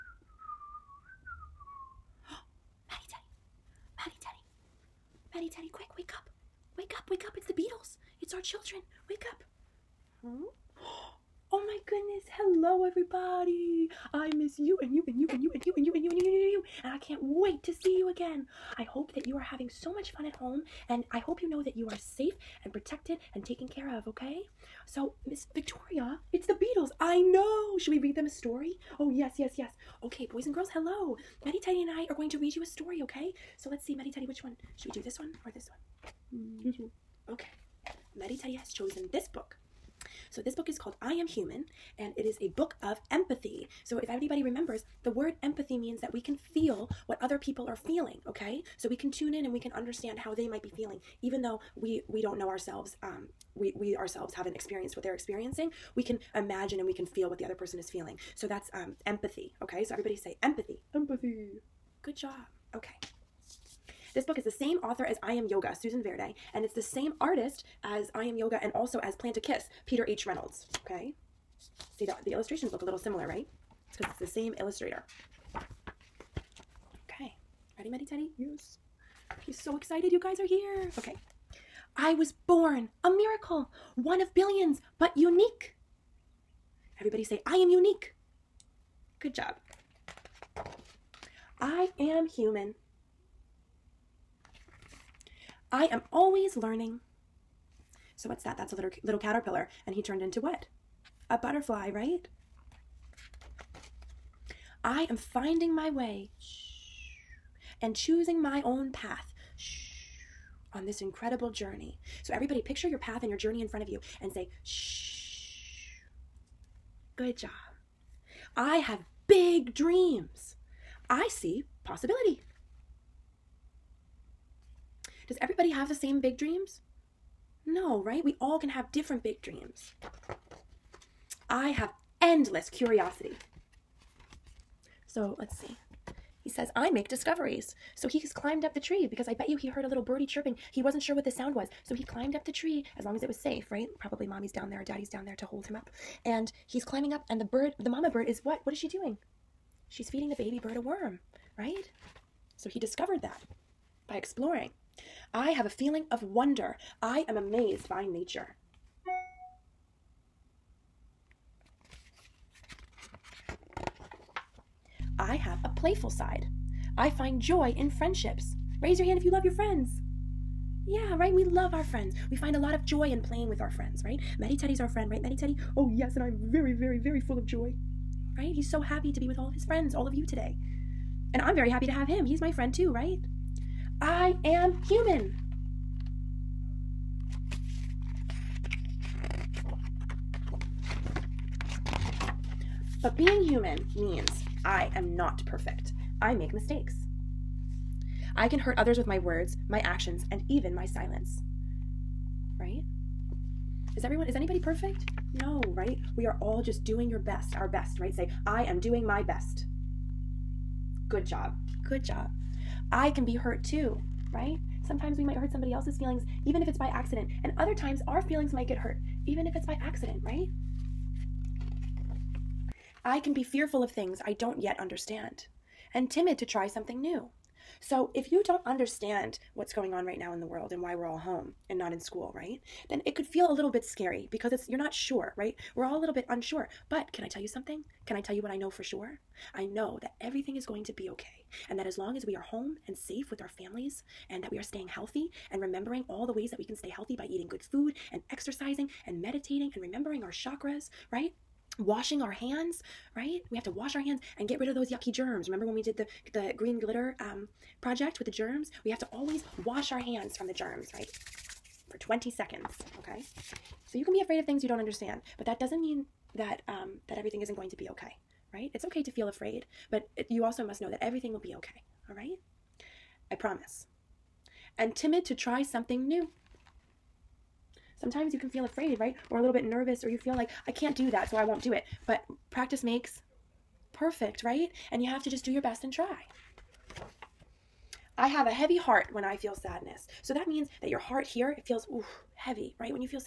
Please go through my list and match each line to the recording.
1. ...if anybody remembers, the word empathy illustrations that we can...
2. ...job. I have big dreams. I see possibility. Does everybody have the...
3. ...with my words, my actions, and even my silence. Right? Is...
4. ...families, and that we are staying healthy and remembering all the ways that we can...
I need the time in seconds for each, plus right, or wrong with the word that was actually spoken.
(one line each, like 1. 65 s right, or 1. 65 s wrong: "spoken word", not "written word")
1. 43 s wrong: "means", not "illustrations"
2. 117 s right
3. 198 s right
4. 243 s right.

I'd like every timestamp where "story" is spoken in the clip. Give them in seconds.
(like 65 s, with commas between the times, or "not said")
28 s, 32 s.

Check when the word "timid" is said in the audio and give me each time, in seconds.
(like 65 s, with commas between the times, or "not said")
226 s, 274 s.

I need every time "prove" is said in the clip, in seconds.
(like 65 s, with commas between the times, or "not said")
not said.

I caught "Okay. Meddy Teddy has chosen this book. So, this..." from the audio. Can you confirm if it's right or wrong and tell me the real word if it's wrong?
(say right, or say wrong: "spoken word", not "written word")
right.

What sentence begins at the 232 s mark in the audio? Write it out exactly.
Then it could feel a little bit scary because it's you're not sure, right?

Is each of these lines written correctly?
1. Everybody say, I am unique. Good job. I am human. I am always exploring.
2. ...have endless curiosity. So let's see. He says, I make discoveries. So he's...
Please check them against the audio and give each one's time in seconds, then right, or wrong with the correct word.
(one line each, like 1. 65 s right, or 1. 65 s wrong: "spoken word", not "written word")
1. 86 s wrong: "learning", not "exploring"
2. 131 s right.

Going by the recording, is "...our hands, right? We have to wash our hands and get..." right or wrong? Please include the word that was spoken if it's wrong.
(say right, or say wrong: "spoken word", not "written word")
right.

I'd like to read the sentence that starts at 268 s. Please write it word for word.
It's okay to feel afraid, but it, you also must know that everything will be okay, all right?